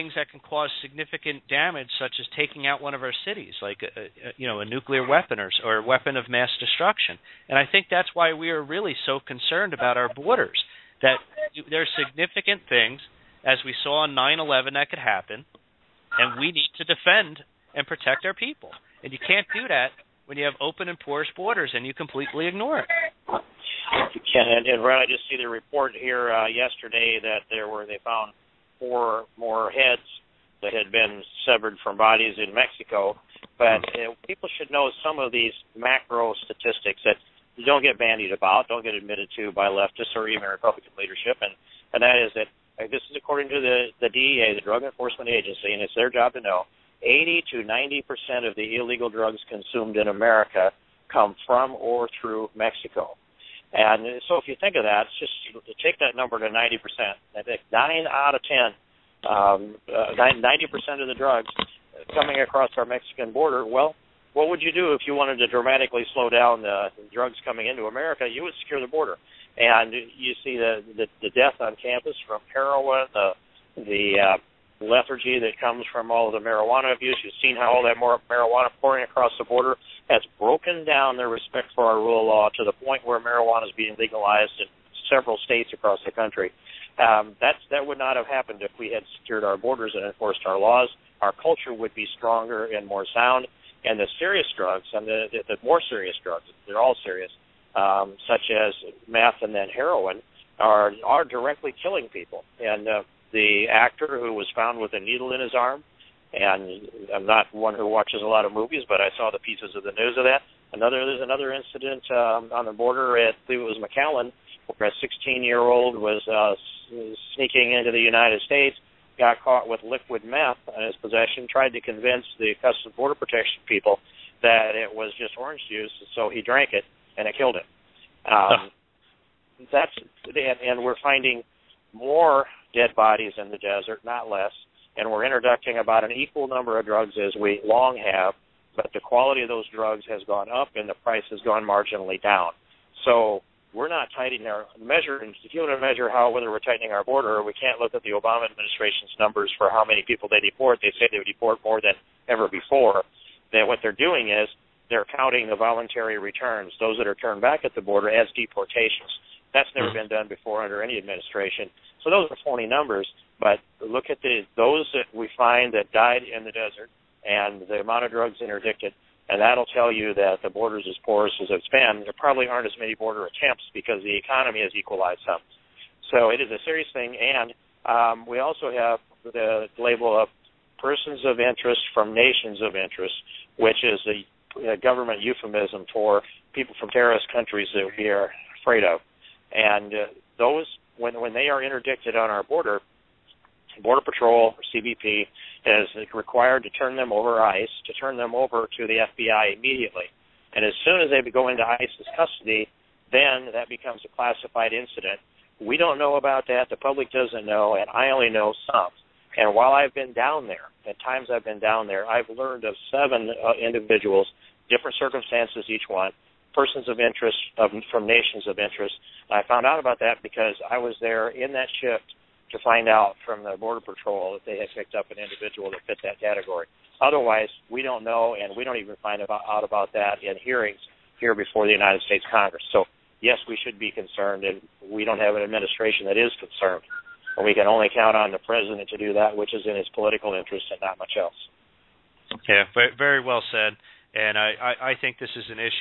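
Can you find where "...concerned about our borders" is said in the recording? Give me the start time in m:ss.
0:09.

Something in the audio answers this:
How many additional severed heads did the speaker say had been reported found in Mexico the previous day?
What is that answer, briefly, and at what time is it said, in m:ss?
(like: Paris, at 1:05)
4, at 0:28.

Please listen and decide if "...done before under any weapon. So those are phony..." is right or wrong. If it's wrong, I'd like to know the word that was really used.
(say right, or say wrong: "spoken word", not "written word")
wrong: "administration", not "weapon".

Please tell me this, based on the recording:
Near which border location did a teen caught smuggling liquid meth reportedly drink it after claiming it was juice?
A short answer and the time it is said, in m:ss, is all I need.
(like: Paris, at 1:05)
McAllen, at 1:53.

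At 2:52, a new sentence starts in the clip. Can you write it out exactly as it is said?
There probably aren't as many border attempts because the economy has equalized some.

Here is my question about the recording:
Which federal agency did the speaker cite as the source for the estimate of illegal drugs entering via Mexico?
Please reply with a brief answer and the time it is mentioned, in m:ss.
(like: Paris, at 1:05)
Drug Enforcement Agency, at 0:44.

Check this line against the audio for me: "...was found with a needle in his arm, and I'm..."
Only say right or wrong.
right.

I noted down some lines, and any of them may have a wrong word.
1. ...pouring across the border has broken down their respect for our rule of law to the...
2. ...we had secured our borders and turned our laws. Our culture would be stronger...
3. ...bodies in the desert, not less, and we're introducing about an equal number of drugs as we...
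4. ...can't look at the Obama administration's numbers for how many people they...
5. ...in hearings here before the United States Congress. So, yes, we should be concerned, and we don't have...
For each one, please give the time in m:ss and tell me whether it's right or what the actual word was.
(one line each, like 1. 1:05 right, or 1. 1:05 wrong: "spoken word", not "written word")
1. 1:18 right
2. 1:28 wrong: "enforced", not "turned"
3. 2:12 right
4. 2:27 right
5. 3:50 right.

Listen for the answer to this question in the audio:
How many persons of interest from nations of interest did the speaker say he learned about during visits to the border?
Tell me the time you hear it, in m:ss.
3:32.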